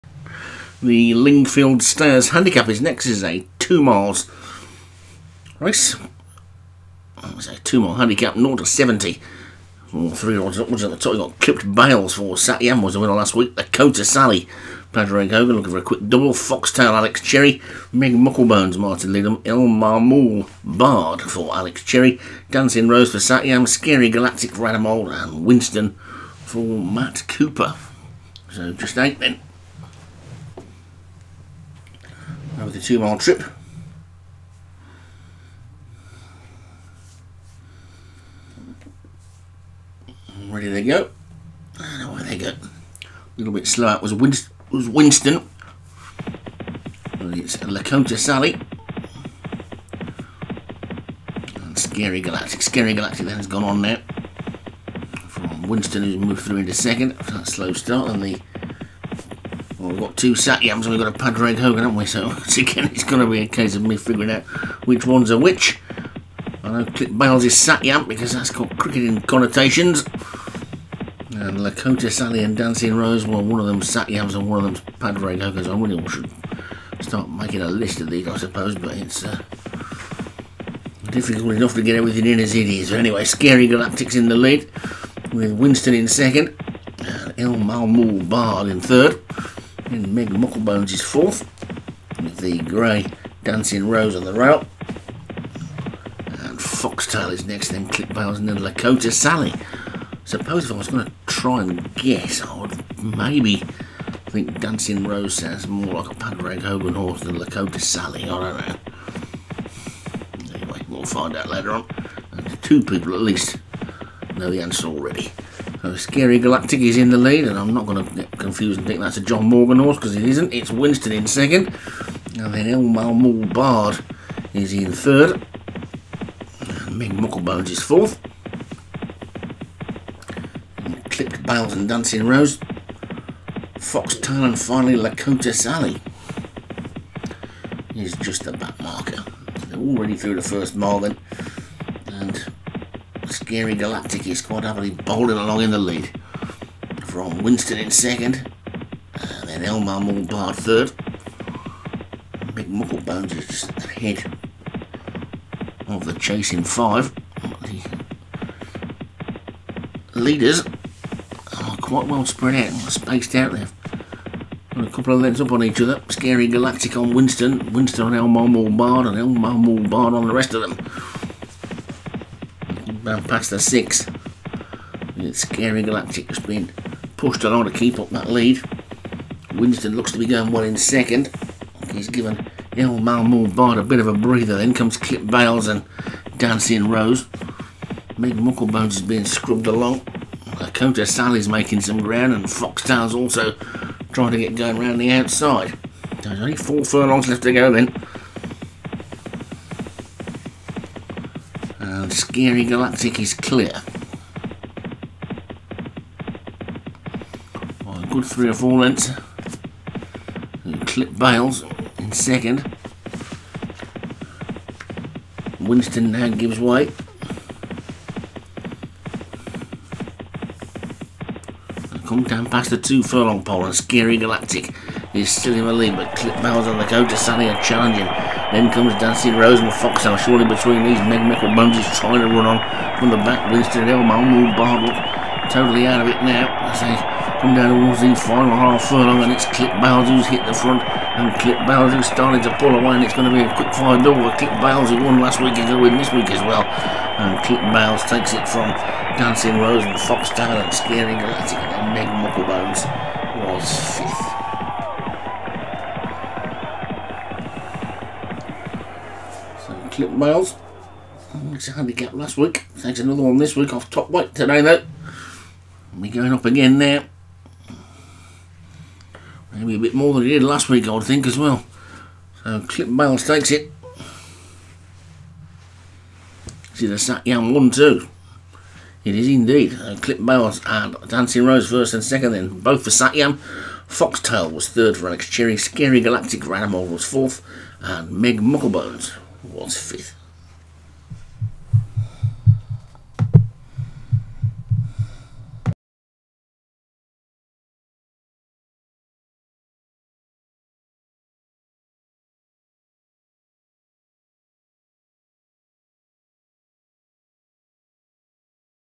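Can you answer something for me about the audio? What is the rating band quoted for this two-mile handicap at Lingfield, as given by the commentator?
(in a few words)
0 to 70.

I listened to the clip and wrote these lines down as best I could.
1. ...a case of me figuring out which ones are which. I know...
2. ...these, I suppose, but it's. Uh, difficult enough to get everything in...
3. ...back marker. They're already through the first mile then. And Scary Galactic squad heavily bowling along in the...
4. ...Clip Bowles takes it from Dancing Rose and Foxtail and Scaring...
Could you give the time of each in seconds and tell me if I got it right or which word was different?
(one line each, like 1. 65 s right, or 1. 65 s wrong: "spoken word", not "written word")
1. 63 s right
2. 78 s right
3. 138 s right
4. 247 s right.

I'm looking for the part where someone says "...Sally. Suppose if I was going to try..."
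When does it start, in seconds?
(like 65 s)
99 s.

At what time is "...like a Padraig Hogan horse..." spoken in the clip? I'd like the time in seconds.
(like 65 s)
106 s.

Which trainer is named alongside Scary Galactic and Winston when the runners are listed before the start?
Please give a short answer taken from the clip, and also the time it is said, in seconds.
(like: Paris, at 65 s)
Matt Cooper, at 26 s.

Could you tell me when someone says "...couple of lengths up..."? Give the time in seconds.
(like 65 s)
164 s.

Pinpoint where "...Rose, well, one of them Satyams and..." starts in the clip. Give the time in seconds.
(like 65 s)
72 s.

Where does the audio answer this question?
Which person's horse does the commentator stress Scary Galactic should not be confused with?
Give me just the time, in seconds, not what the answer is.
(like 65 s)
119 s.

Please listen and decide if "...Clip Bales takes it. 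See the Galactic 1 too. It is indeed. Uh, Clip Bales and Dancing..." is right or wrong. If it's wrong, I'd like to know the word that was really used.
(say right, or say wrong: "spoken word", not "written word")
wrong: "Satyam", not "Galactic".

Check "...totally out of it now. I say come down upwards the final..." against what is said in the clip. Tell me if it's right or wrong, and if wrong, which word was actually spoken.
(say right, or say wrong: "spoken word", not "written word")
wrong: "towards", not "upwards".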